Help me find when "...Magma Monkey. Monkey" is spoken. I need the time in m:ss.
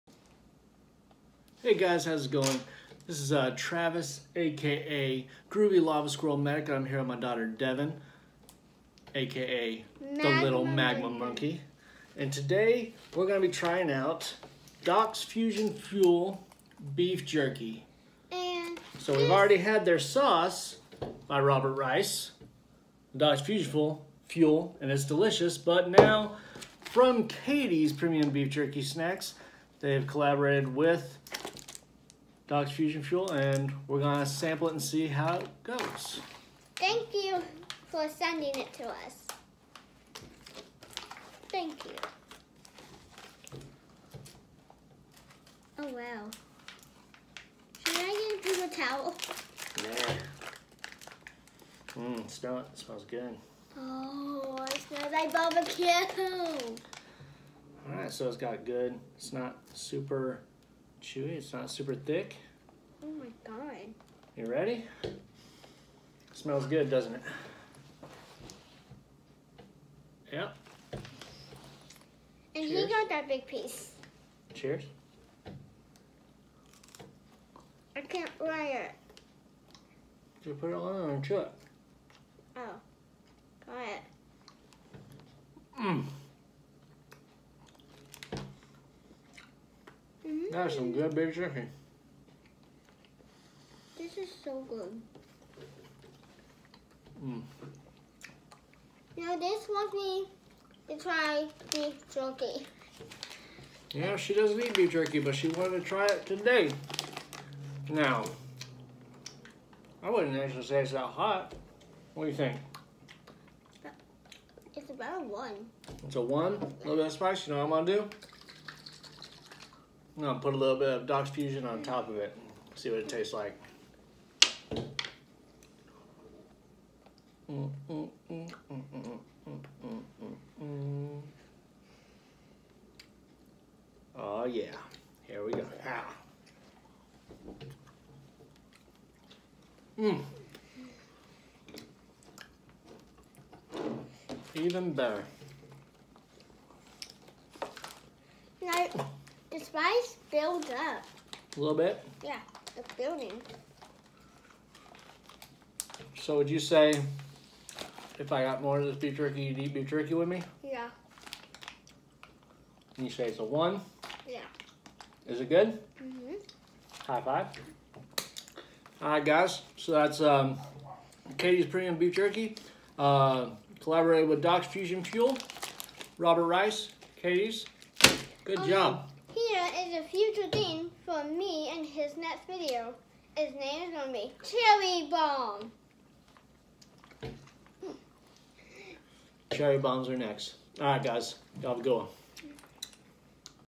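0:10.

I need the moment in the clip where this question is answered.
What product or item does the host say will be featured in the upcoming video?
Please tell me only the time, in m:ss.
3:04.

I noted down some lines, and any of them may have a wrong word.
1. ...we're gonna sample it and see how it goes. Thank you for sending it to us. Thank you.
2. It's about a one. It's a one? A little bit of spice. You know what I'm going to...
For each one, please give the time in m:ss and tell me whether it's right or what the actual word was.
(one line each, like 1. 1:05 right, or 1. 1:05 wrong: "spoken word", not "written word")
1. 0:33 right
2. 1:54 right.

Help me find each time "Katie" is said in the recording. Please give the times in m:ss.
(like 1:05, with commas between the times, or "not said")
0:27, 2:51, 2:57.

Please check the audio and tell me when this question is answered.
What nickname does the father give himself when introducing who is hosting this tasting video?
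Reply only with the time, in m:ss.
0:05.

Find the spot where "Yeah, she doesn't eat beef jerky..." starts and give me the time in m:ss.
1:43.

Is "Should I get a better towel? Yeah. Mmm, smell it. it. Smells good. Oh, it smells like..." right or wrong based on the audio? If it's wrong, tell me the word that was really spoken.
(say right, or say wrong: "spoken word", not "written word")
wrong: "paper", not "better".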